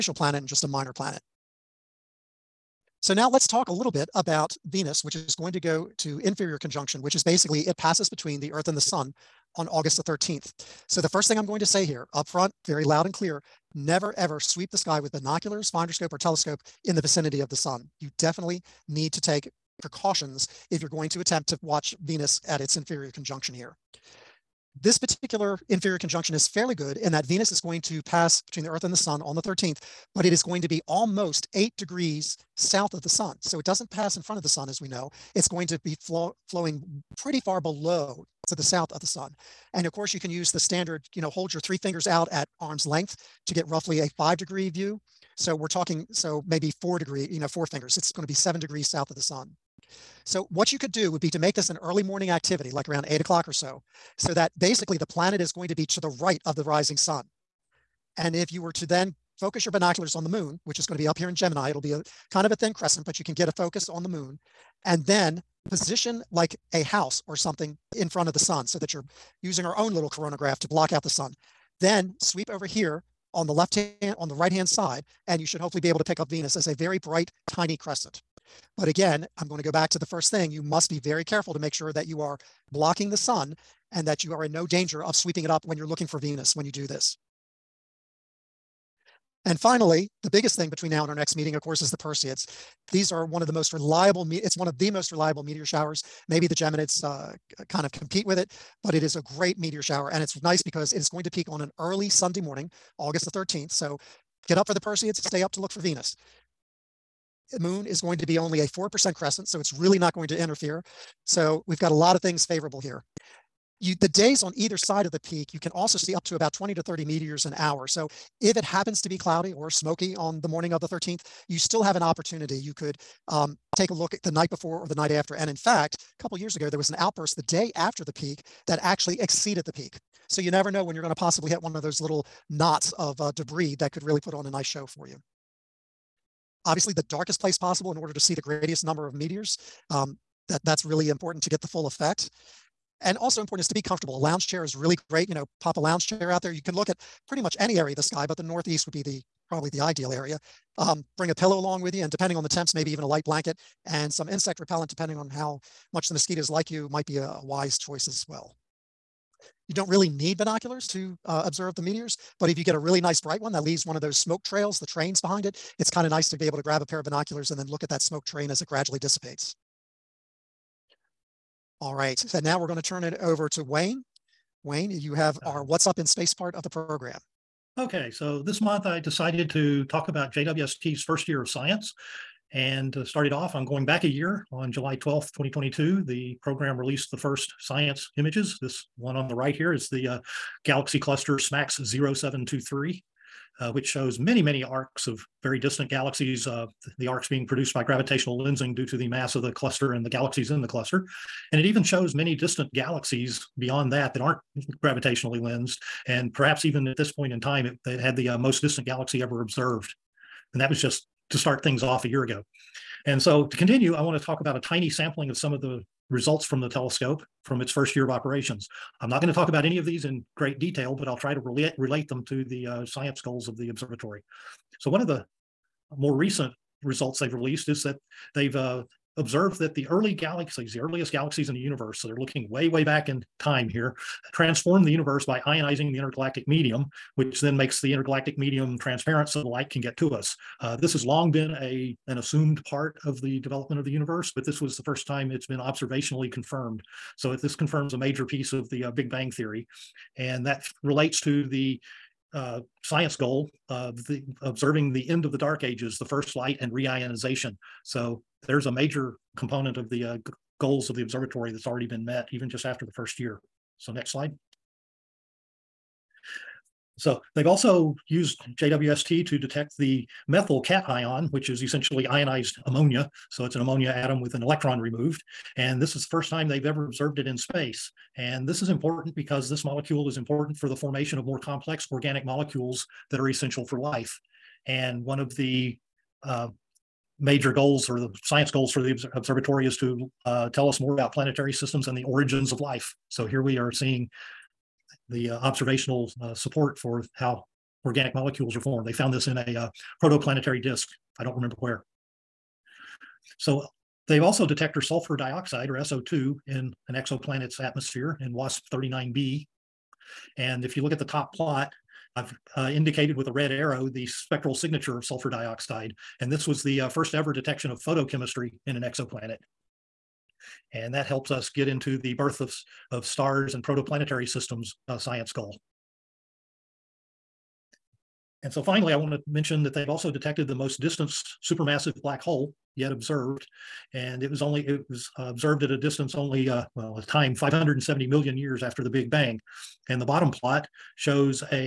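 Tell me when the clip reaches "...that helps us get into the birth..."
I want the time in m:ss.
5:20.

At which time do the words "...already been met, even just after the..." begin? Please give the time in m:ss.
4:21.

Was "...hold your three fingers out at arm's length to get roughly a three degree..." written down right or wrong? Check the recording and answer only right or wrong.
wrong.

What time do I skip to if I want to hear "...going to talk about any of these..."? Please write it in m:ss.
3:39.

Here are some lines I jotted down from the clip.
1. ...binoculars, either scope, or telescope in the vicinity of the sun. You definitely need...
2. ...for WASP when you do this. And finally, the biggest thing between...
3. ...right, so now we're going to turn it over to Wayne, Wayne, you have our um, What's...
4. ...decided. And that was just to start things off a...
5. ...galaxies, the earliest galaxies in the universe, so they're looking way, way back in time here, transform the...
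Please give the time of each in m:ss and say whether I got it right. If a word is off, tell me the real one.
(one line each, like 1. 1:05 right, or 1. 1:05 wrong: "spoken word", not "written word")
1. 0:15 wrong: "finder", not "either"
2. 1:26 wrong: "Venus", not "WASP"
3. 2:51 right
4. 3:29 wrong: "observed", not "decided"
5. 3:50 right.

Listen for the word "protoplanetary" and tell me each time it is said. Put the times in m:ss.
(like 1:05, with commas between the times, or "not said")
5:00, 5:23.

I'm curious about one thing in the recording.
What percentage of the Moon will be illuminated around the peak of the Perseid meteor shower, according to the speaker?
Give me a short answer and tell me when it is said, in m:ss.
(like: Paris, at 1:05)
4%, at 1:48.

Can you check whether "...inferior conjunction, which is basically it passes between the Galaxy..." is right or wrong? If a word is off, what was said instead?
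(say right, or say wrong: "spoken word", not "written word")
wrong: "Earth", not "Galaxy".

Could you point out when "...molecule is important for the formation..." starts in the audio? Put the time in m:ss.
4:39.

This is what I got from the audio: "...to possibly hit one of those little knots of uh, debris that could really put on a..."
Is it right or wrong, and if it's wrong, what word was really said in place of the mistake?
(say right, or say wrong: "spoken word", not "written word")
right.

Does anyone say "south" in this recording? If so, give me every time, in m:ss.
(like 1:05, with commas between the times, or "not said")
0:32, 0:38, 0:48.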